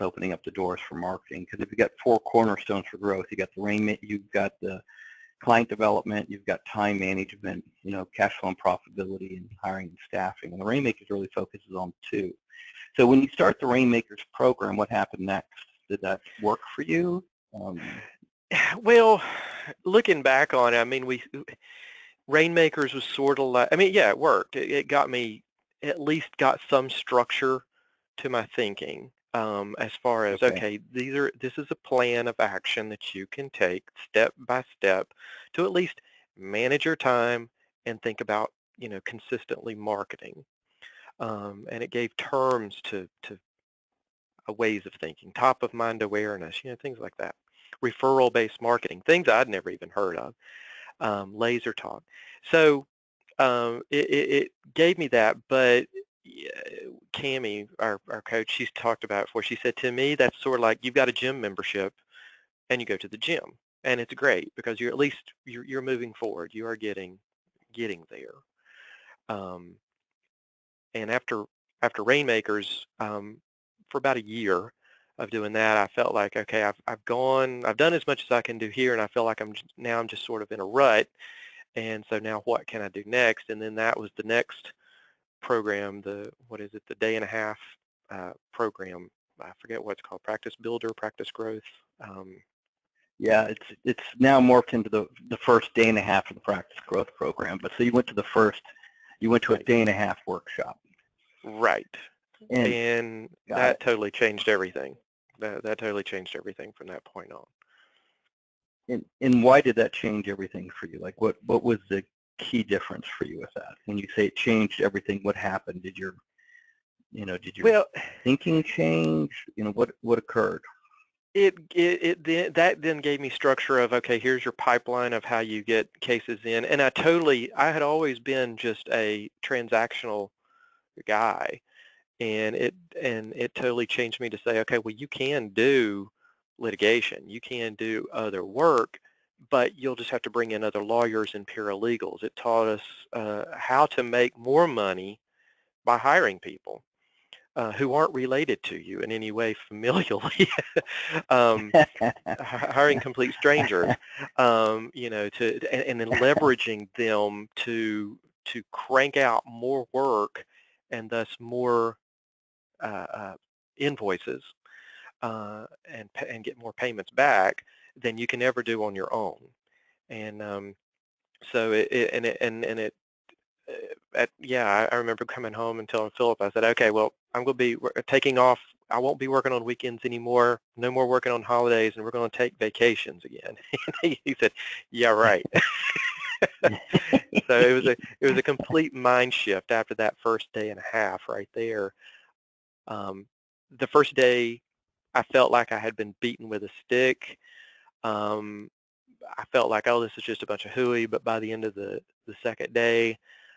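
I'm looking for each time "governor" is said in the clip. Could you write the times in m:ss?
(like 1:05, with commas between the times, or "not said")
not said.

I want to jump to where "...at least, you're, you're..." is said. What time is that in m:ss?
1:04.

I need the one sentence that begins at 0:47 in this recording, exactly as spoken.
Referral-based marketing, things I'd never even heard of, um, laser talk.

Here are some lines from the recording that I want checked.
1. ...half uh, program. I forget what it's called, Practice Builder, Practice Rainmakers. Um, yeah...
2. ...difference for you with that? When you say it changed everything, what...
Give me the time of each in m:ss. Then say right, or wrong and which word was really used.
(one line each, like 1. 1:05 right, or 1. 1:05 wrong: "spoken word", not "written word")
1. 1:27 wrong: "Growth", not "Rainmakers"
2. 1:52 right.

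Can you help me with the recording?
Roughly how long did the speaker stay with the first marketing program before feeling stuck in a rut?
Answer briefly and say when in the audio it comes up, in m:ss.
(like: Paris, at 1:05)
about a year, at 1:13.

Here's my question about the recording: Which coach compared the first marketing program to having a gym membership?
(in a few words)
Cami.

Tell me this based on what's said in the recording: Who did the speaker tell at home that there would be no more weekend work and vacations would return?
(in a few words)
Philip.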